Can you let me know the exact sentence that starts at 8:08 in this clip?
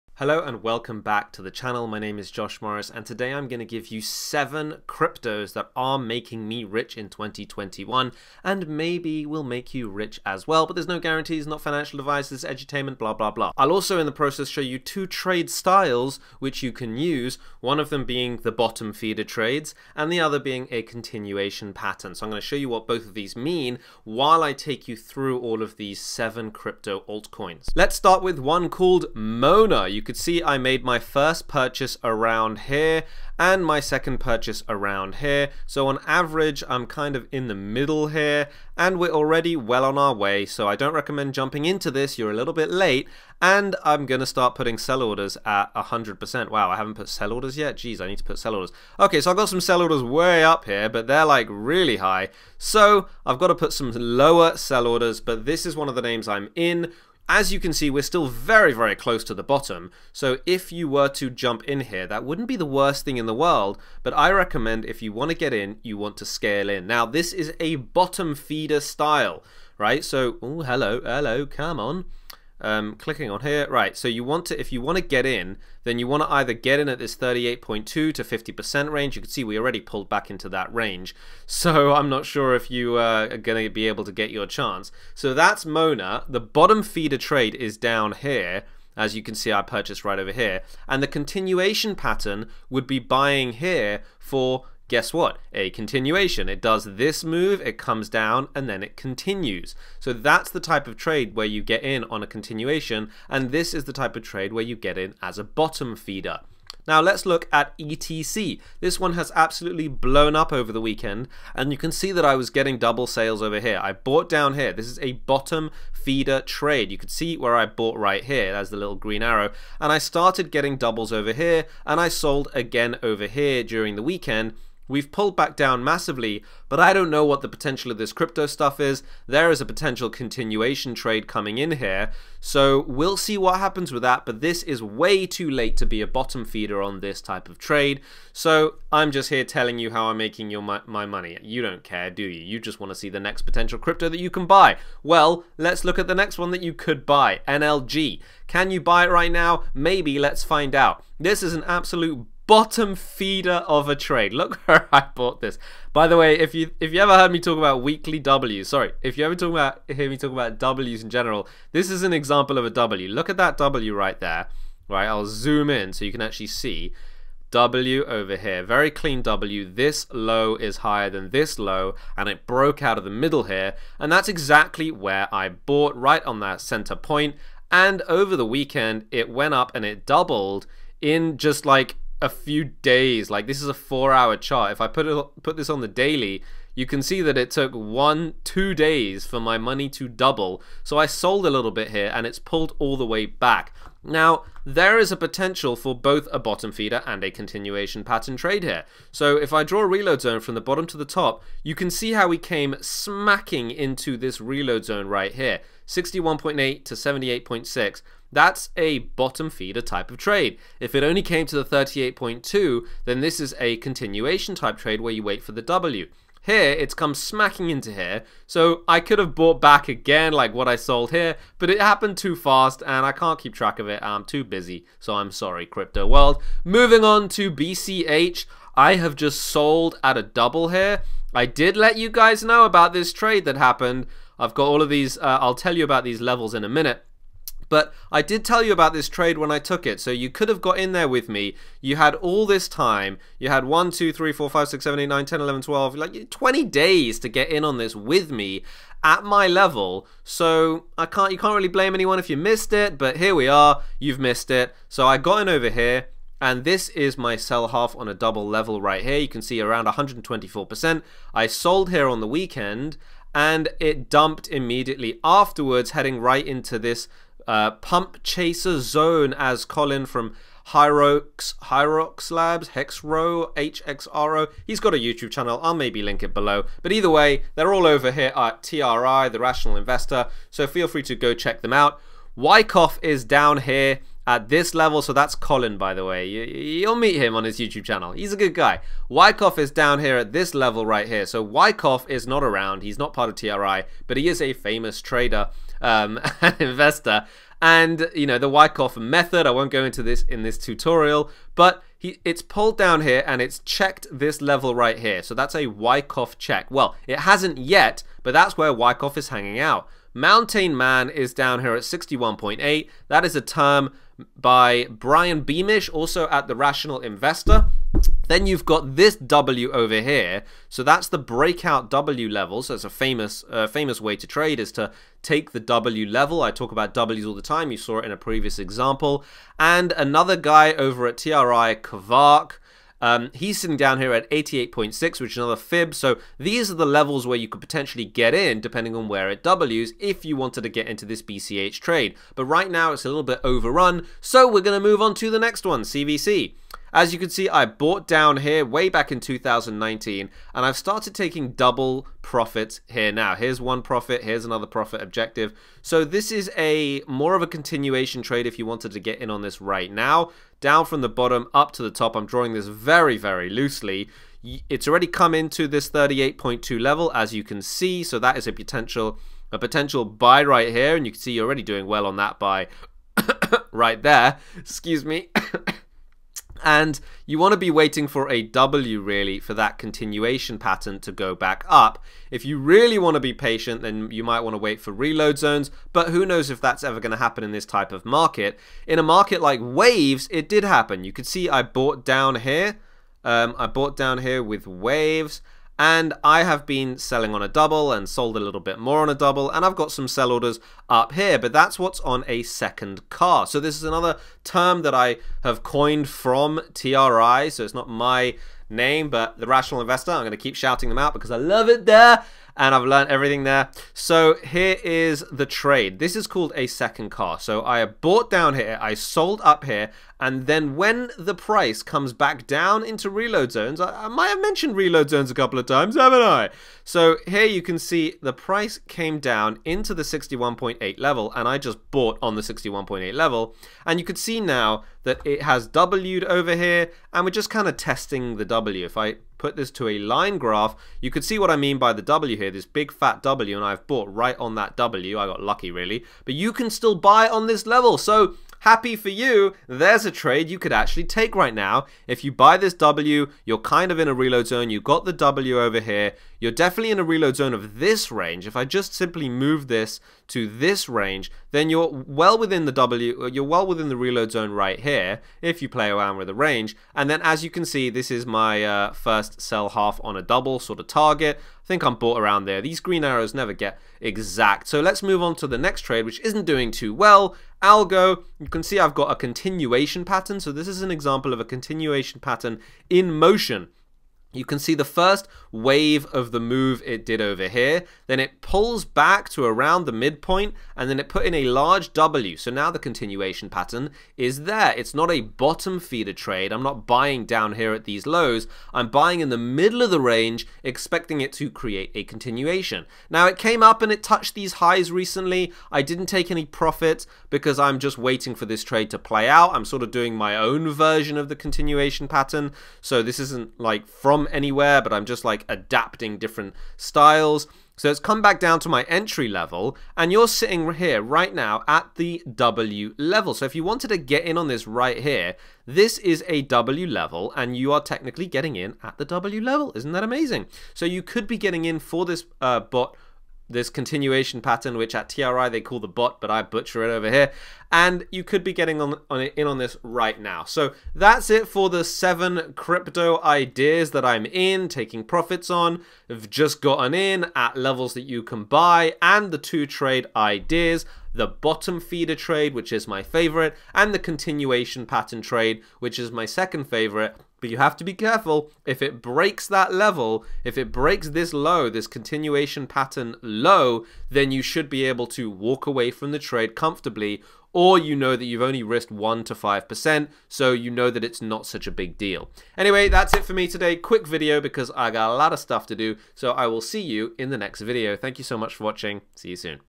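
Then it pulls back to around the midpoint and then it put in a large W.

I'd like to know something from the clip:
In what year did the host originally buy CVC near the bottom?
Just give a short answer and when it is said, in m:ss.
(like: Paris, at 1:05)
2019, at 5:49.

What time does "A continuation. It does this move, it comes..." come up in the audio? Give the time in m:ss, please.
1:35.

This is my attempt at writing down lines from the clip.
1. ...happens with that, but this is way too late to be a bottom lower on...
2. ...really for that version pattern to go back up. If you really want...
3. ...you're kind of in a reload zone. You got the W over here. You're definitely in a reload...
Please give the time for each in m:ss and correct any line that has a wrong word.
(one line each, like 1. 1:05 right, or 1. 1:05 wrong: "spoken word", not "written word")
1. 2:13 wrong: "feeder", not "lower"
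2. 6:19 wrong: "continuation", not "version"
3. 7:33 right.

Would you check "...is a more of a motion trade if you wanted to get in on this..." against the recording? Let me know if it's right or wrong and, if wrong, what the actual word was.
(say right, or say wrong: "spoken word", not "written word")
wrong: "continuation", not "motion".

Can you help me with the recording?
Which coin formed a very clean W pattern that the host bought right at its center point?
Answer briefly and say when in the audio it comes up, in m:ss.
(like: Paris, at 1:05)
NLG, at 2:27.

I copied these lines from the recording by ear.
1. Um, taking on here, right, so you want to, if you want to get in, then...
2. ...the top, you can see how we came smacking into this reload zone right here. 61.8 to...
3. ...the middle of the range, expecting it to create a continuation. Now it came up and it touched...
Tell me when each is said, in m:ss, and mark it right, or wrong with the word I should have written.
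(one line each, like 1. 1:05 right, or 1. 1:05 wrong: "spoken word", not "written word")
1. 1:12 wrong: "clicking", not "taking"
2. 3:20 right
3. 8:19 right.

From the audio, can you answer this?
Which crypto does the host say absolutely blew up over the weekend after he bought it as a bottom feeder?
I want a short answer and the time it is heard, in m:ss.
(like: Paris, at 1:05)
ETC, at 1:47.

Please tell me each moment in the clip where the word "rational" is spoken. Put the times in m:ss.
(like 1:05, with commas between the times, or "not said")
4:39, 5:16, 6:49.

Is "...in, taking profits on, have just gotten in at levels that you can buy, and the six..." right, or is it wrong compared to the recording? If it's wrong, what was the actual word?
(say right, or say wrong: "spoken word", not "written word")
wrong: "two", not "six".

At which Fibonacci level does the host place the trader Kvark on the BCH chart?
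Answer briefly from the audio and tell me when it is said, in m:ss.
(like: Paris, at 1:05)
88.6, at 5:34.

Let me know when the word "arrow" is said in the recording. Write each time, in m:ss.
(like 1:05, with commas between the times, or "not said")
1:59, 7:53.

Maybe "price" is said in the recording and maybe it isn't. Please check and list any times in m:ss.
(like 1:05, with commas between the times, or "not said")
7:01, 7:08.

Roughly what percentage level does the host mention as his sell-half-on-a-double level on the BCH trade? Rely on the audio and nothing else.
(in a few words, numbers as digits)
124%.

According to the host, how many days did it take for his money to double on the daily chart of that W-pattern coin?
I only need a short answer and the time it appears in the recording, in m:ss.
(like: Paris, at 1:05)
2, at 3:08.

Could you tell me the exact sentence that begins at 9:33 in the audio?
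Quick video because I got a lot of stuff to do, so I will see you in the next video.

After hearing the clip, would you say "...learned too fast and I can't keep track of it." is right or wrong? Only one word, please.
wrong.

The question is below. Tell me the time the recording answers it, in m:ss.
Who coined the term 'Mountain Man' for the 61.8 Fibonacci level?
5:14.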